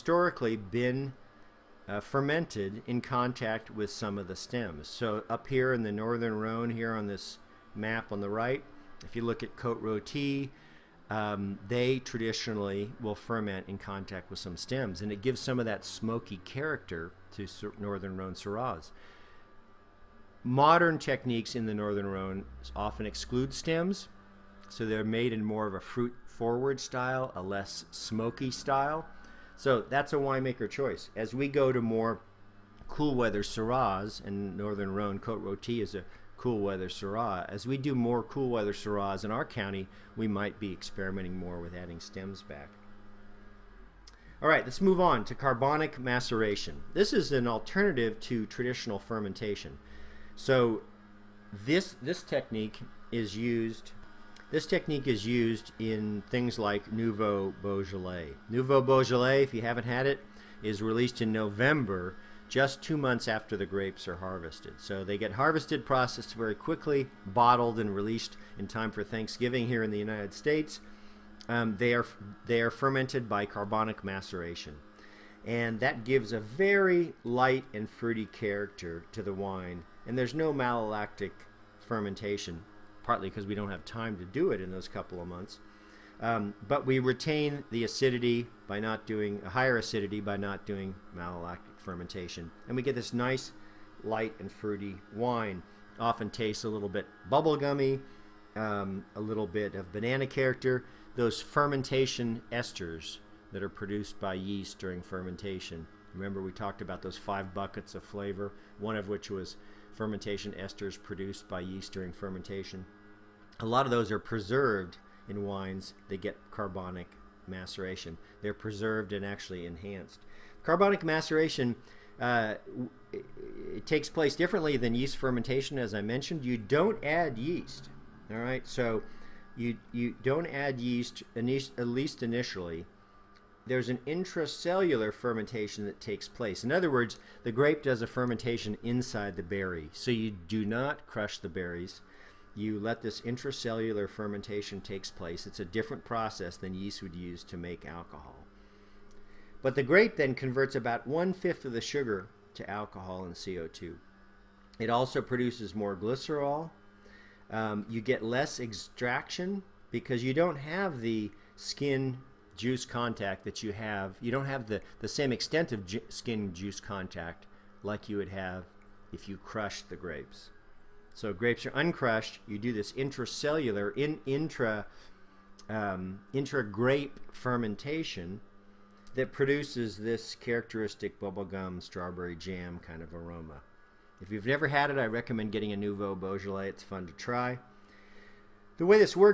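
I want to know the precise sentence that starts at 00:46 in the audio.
This is an alternative to traditional fermentation.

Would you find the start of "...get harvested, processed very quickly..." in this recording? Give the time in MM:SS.
01:05.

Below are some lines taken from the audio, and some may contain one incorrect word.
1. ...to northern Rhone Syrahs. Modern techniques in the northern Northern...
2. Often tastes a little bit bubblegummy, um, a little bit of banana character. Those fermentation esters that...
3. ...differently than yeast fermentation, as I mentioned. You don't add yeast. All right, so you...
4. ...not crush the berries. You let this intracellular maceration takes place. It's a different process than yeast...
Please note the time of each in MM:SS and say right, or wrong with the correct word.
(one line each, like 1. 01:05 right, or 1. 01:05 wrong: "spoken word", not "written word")
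1. 00:17 wrong: "Rhone", not "Northern"
2. 01:35 right
3. 02:04 right
4. 02:20 wrong: "fermentation", not "maceration".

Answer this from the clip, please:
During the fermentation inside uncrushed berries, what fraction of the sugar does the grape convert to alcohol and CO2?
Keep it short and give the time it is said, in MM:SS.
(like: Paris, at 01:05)
one fifth, at 02:31.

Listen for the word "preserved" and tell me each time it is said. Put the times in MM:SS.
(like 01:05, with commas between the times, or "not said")
01:54, 01:58.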